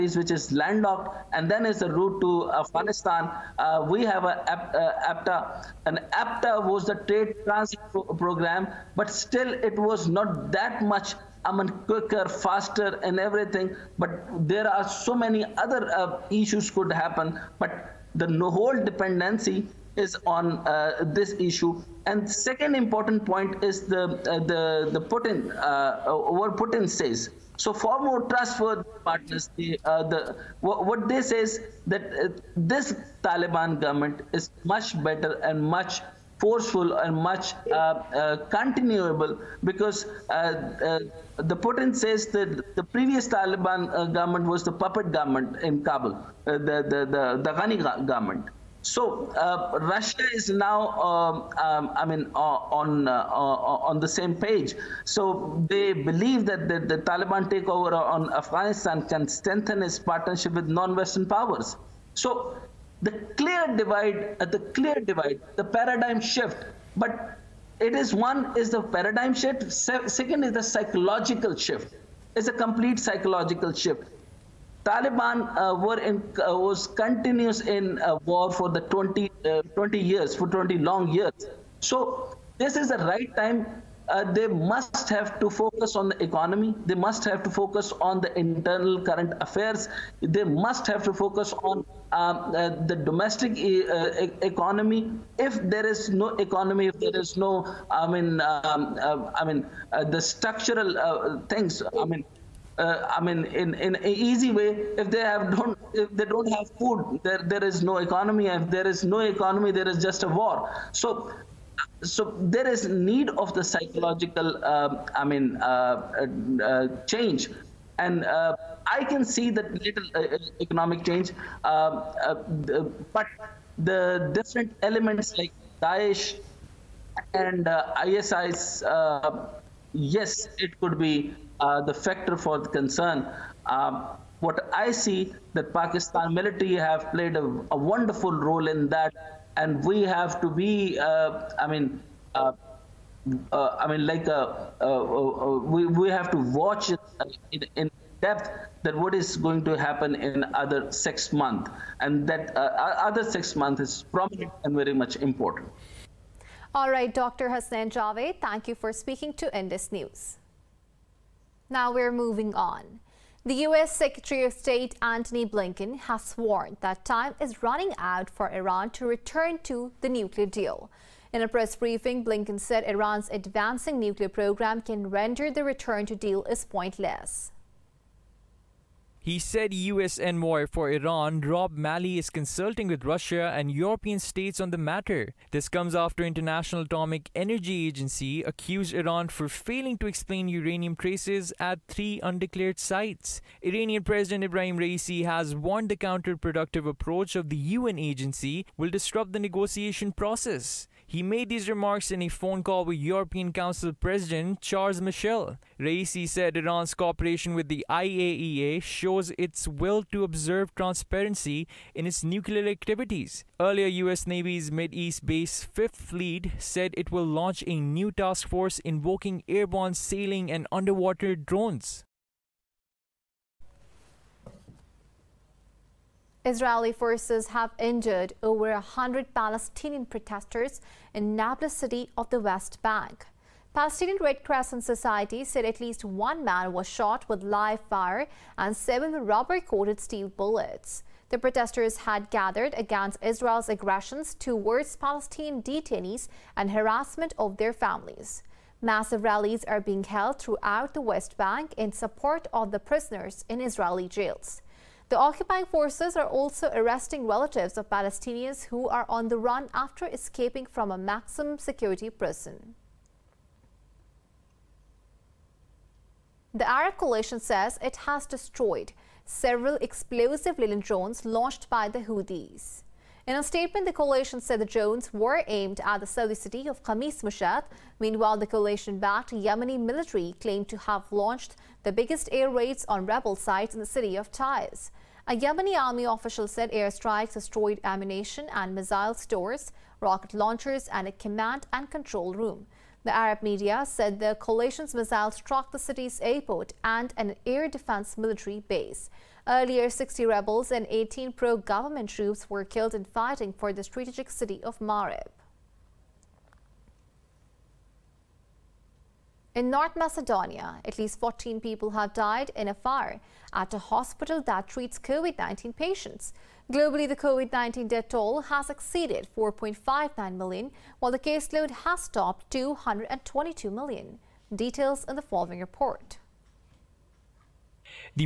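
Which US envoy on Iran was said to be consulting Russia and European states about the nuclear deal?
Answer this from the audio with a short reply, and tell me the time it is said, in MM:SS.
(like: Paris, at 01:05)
Rob Malley, at 03:01.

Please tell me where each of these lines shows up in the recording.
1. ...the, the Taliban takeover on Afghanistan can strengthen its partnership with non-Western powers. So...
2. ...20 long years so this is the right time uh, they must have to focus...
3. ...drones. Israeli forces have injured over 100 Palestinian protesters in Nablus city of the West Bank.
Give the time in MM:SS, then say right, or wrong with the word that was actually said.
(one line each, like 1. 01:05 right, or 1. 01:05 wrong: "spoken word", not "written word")
1. 00:56 right
2. 01:20 right
3. 03:41 right.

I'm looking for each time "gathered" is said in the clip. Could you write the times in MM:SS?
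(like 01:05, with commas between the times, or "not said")
04:02.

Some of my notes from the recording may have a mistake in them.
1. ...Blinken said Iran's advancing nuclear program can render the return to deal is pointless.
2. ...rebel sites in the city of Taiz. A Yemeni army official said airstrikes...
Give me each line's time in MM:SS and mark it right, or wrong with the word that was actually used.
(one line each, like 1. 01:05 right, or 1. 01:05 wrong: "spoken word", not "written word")
1. 02:52 right
2. 04:43 right.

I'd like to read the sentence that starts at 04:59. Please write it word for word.
Earlier, 60 rebels and 18 pro-government troops were killed in fighting for the strategic city of Marib.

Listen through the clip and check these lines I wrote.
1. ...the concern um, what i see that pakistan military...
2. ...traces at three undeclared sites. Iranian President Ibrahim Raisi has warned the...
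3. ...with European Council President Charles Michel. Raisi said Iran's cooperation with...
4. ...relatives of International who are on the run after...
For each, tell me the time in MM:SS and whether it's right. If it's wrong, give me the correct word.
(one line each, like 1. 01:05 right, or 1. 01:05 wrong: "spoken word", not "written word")
1. 02:12 right
2. 03:10 right
3. 03:22 right
4. 04:17 wrong: "Palestinians", not "International".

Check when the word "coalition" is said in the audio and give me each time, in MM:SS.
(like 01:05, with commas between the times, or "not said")
04:26, 04:33, 04:38, 04:54.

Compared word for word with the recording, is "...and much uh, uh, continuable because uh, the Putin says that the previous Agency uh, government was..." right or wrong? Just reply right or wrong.
wrong.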